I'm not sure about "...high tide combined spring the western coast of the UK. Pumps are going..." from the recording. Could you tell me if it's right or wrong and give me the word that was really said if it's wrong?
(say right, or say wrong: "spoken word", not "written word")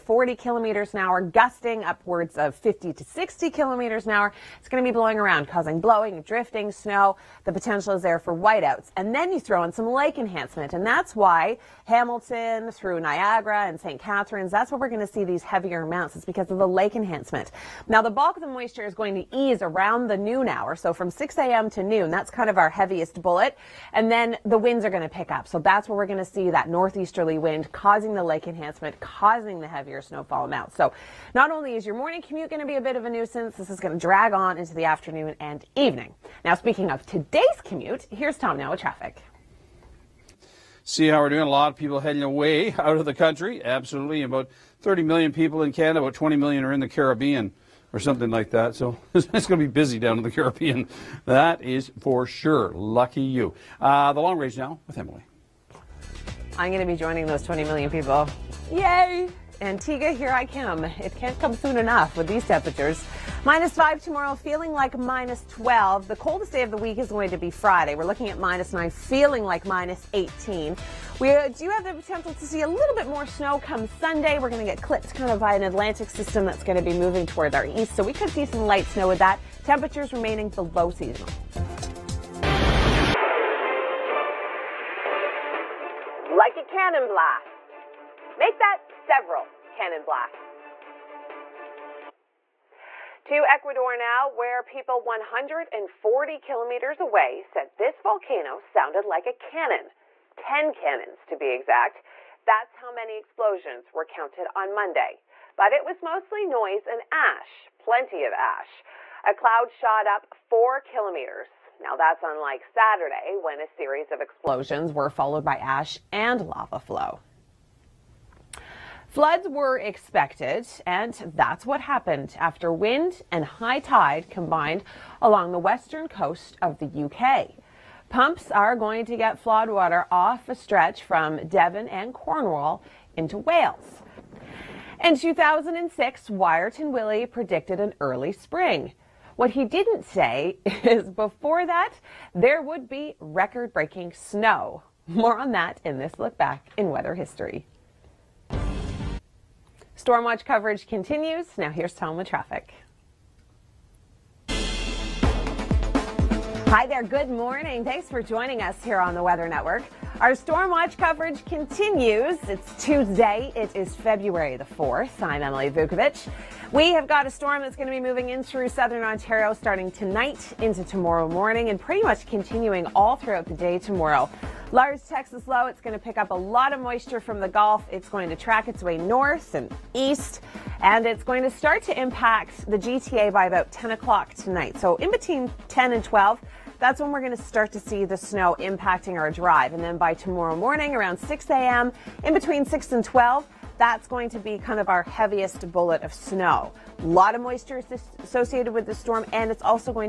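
wrong: "along", not "spring".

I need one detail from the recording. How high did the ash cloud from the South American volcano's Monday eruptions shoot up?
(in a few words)
4 kilometers.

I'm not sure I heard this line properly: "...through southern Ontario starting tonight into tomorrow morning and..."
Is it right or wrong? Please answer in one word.
right.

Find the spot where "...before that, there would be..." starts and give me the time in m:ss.
2:21.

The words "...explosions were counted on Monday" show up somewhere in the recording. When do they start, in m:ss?
1:43.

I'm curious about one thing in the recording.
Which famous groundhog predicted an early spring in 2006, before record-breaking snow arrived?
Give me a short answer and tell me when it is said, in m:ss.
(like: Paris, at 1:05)
Wiarton Willie, at 2:16.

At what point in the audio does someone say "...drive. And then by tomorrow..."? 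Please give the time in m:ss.
3:09.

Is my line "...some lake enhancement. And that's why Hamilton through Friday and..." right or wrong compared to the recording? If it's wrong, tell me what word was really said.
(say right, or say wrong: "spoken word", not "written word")
wrong: "Niagara", not "Friday".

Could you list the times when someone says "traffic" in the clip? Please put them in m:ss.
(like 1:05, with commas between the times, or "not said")
0:38, 2:32.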